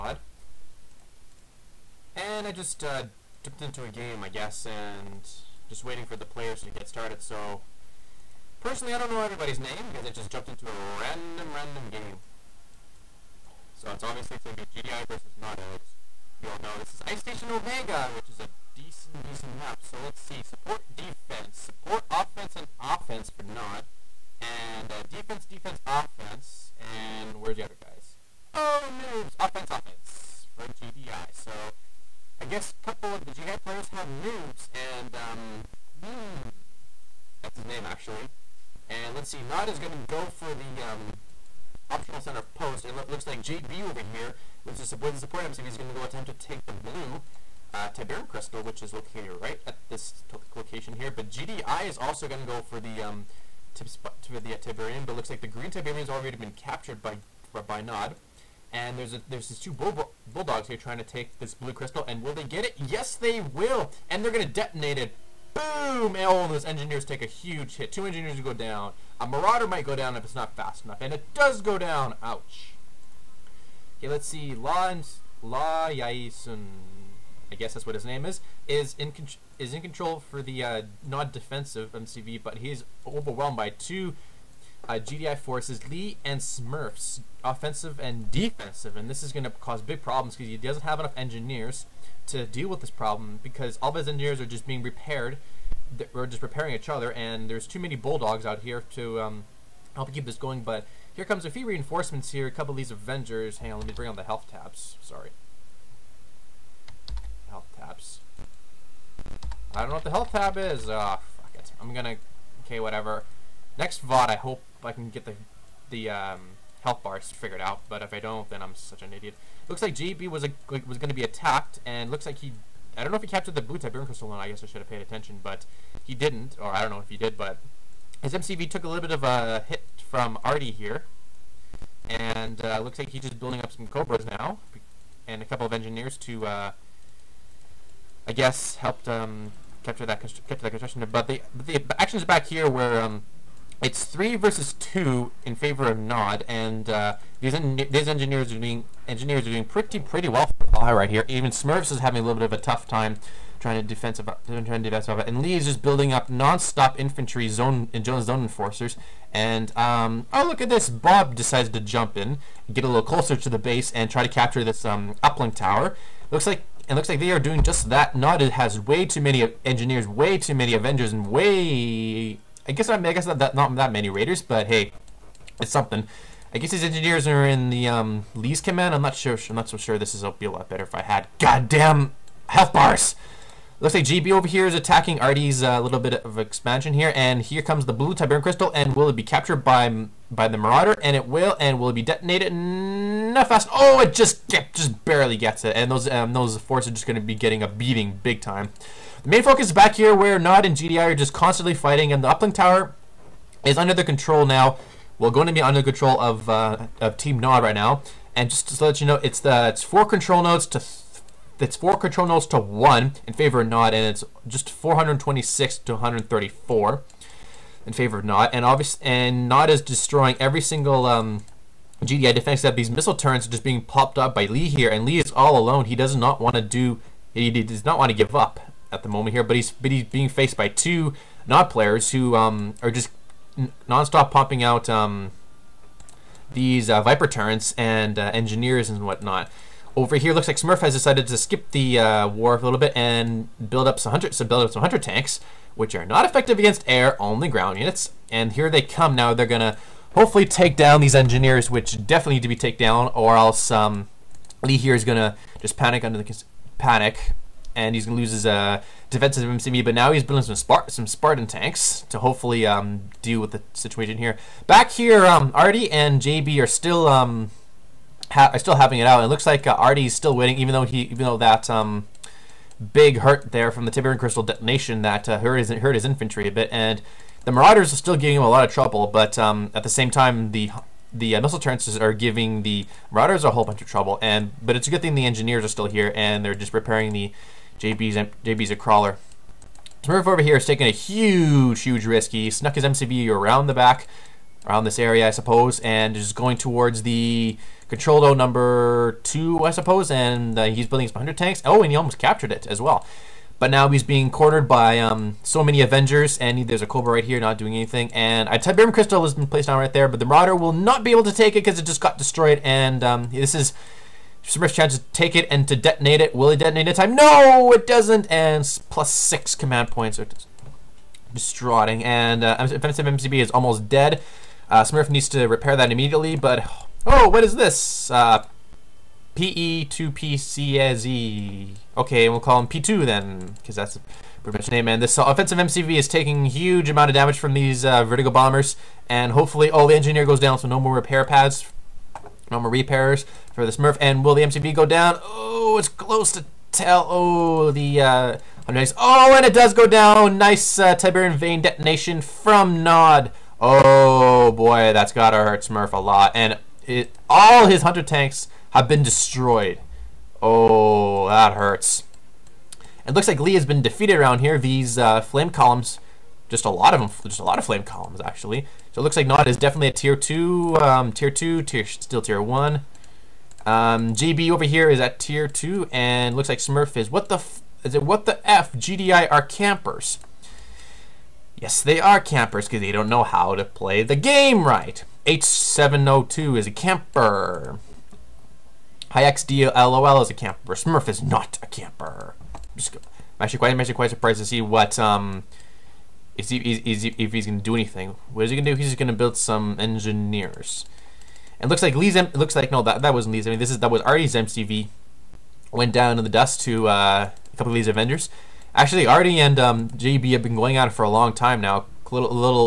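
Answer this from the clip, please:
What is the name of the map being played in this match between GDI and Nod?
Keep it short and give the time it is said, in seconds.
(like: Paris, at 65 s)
Ice Station Omega, at 17 s.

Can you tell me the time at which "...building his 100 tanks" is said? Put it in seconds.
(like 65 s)
300 s.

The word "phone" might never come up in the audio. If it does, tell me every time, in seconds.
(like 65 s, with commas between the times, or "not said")
not said.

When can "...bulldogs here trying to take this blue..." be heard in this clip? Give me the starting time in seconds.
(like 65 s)
60 s.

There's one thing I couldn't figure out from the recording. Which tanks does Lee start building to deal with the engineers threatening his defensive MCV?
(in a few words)
Spartan tanks.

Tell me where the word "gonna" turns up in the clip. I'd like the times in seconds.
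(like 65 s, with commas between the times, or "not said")
111 s, 249 s, 255 s.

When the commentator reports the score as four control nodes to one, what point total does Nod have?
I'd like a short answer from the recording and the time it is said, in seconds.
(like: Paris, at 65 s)
426, at 214 s.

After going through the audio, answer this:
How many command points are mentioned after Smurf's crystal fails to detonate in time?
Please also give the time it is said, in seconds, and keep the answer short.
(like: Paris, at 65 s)
6, at 319 s.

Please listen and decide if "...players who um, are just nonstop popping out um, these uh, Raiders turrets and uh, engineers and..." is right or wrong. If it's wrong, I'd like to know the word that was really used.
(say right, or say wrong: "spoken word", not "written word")
wrong: "Viper", not "Raiders".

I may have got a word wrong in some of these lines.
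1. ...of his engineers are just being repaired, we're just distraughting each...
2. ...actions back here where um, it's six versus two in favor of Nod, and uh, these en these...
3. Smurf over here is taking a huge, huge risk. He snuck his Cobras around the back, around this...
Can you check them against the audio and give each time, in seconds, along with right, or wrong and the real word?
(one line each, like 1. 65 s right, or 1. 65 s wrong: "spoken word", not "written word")
1. 93 s wrong: "repairing", not "distraughting"
2. 142 s wrong: "three", not "six"
3. 290 s wrong: "MCV", not "Cobras".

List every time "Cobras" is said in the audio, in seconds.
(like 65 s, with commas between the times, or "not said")
133 s, 306 s.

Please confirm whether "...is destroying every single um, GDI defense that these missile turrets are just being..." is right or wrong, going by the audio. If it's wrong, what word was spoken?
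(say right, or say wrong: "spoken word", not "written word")
right.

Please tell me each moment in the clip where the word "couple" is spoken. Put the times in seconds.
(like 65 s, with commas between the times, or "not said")
32 s, 102 s, 135 s, 407 s.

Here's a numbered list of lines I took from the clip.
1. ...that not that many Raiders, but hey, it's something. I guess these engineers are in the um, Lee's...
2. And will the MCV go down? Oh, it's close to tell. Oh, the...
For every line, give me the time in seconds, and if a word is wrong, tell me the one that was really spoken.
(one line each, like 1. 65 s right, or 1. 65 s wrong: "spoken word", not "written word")
1. 173 s right
2. 343 s right.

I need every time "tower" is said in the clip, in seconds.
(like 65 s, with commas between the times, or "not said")
165 s, 202 s.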